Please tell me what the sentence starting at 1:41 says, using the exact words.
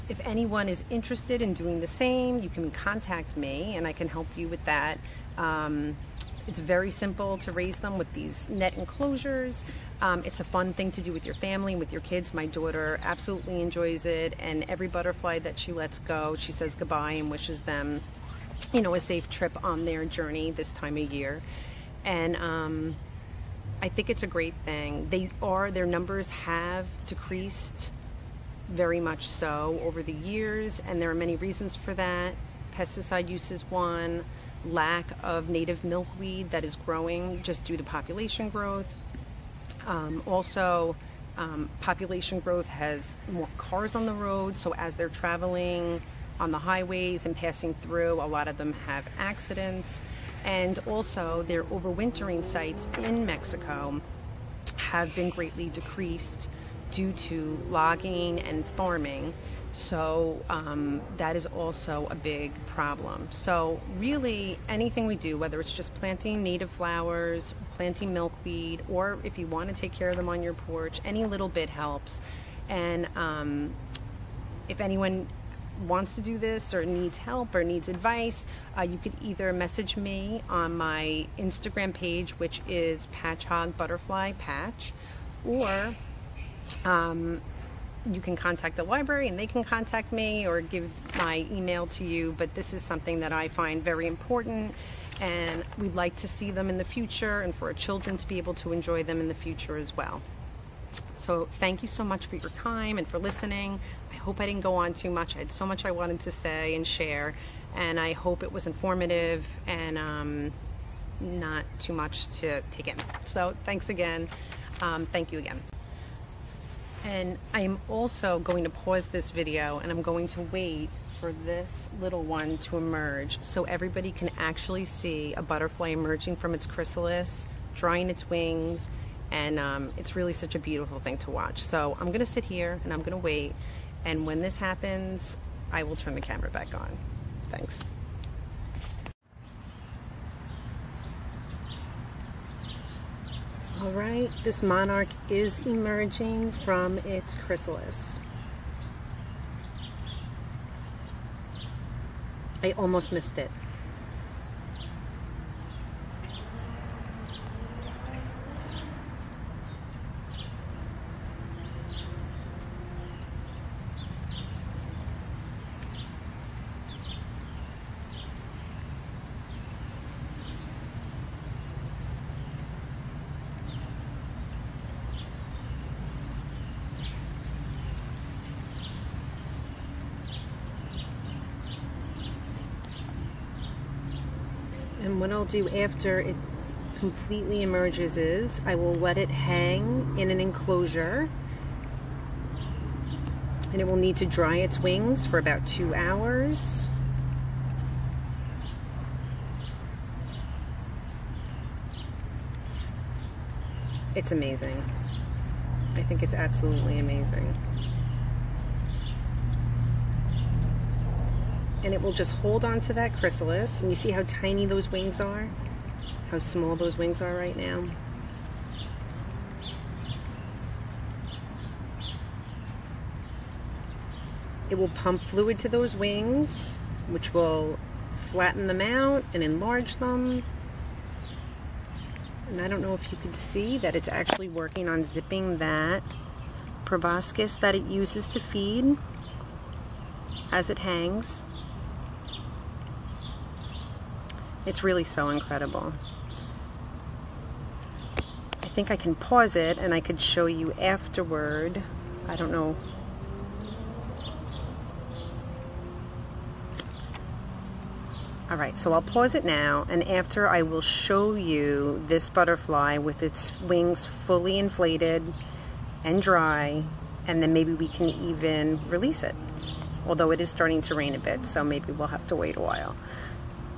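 So thank you so much for your time and for listening.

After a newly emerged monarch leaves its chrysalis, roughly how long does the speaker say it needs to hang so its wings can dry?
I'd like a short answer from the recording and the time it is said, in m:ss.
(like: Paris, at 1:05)
2 hours, at 3:15.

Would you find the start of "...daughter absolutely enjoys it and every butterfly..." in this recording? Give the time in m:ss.
0:12.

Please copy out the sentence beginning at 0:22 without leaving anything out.
And um, I think it's a great thing.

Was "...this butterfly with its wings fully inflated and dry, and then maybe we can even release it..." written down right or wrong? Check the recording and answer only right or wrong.
right.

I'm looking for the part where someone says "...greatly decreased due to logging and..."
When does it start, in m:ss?
0:55.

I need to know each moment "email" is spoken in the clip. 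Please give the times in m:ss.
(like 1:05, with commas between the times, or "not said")
1:31.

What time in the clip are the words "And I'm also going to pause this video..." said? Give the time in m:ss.
1:57.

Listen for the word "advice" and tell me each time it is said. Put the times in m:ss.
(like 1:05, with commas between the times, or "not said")
1:17.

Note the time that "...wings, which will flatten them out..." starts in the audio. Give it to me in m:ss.
3:45.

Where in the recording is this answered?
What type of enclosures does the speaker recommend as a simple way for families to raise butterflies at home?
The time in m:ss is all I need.
0:08.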